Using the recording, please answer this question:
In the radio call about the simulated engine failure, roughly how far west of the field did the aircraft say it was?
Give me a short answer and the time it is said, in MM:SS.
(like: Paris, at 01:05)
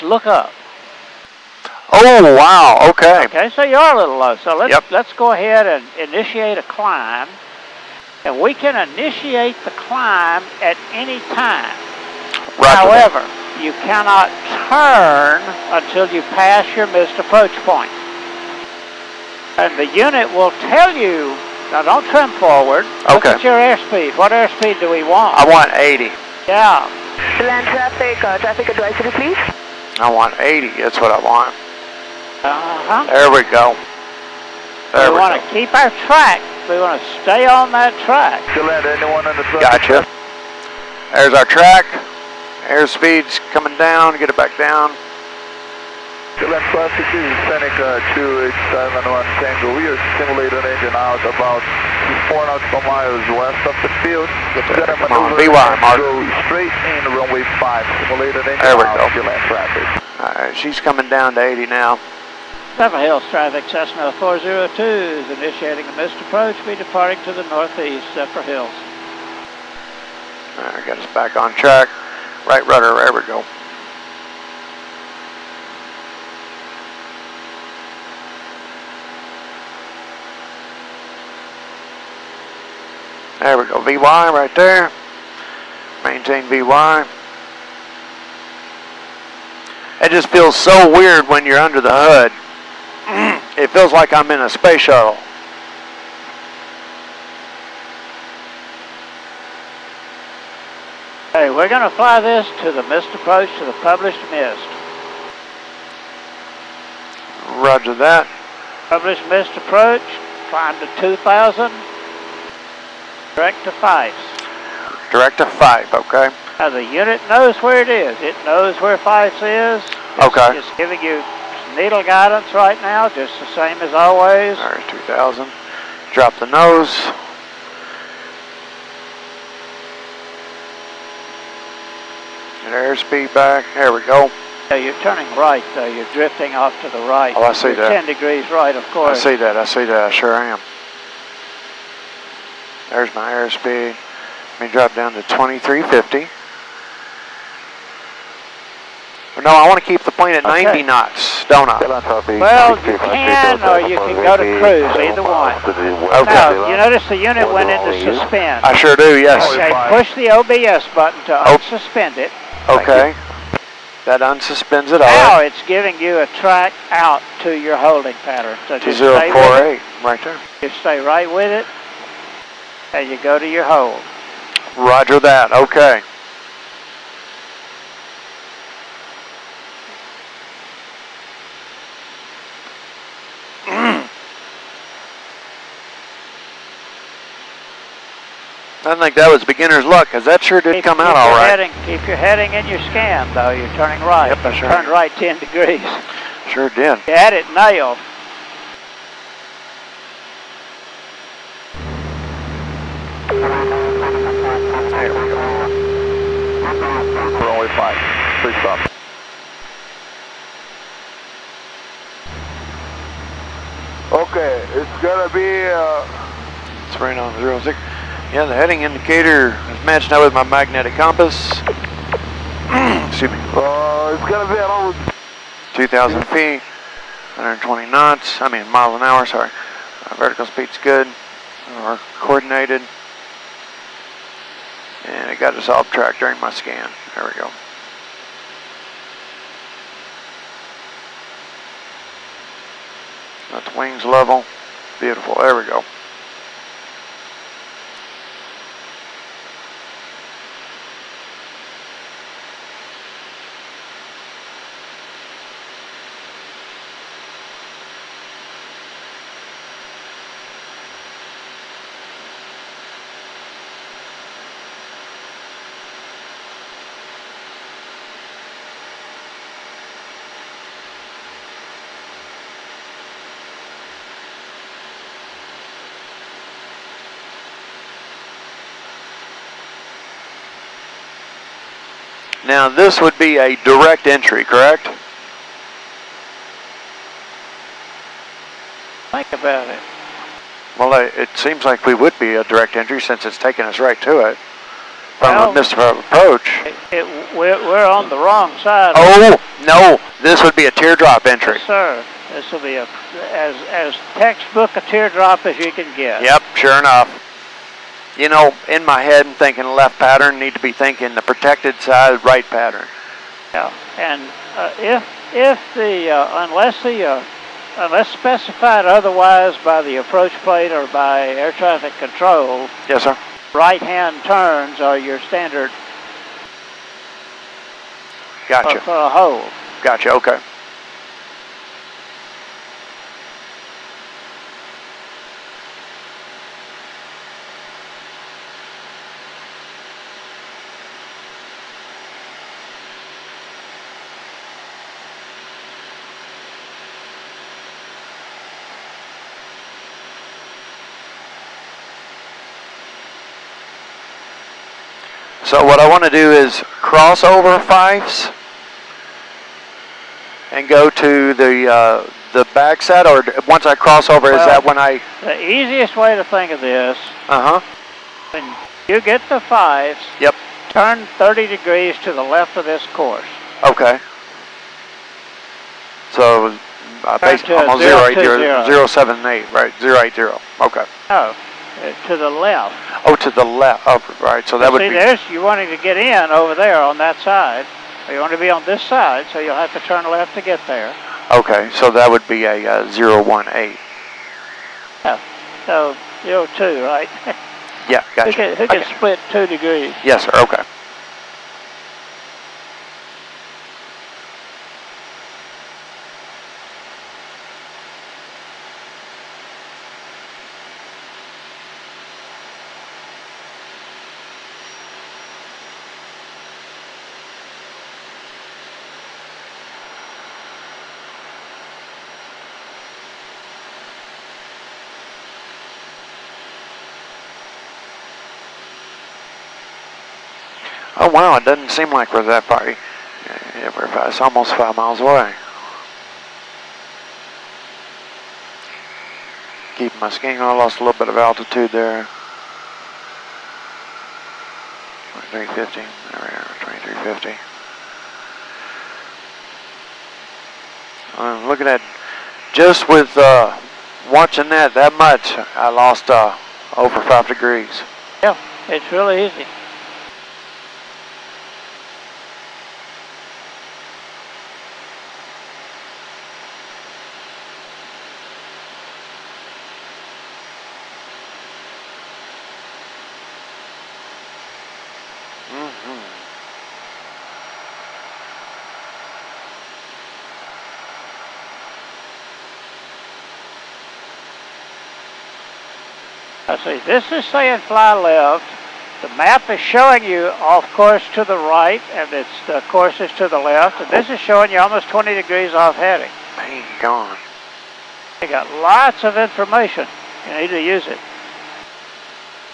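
4 nautical miles, at 00:52.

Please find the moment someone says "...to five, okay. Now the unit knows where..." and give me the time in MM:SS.
01:55.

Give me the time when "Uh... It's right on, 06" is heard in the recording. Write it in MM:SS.
03:35.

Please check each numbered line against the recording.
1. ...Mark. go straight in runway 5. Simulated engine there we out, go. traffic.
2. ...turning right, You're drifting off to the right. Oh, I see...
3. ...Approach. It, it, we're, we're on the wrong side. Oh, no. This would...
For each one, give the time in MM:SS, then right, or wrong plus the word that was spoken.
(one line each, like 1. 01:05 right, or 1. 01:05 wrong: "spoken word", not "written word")
1. 00:55 right
2. 02:15 right
3. 04:55 right.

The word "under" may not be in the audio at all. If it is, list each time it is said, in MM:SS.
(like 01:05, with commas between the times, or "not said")
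01:31.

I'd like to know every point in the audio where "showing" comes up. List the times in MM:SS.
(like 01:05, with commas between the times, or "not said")
08:09, 08:14.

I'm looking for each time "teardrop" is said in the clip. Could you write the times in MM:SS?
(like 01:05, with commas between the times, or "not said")
05:00, 05:04.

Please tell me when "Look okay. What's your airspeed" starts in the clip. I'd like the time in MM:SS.
00:23.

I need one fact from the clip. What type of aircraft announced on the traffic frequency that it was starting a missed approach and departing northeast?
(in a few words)
Cessna 402.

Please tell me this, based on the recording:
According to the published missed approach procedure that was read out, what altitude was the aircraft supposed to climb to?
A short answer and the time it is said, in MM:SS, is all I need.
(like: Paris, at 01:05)
2,000, at 01:50.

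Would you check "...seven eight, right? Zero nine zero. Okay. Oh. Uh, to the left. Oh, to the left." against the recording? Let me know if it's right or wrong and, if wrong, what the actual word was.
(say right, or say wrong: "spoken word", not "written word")
wrong: "eight", not "nine".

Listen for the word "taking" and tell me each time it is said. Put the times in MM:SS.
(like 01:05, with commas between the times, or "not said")
04:53.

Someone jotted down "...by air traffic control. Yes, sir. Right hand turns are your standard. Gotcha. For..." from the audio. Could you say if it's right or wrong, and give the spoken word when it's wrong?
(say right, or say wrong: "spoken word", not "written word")
right.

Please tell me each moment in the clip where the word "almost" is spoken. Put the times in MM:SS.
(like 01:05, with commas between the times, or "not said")
06:17, 07:14, 08:14.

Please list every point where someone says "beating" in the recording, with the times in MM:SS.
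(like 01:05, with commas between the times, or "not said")
not said.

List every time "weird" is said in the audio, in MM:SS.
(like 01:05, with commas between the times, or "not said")
01:30.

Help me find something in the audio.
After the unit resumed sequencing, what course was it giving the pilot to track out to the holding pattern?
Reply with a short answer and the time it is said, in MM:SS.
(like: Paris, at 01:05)
048, at 02:48.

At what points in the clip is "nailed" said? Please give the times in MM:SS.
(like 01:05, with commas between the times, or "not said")
03:17.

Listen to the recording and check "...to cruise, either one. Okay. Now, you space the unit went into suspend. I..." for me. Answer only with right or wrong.
wrong.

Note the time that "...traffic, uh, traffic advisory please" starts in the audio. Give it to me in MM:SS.
00:27.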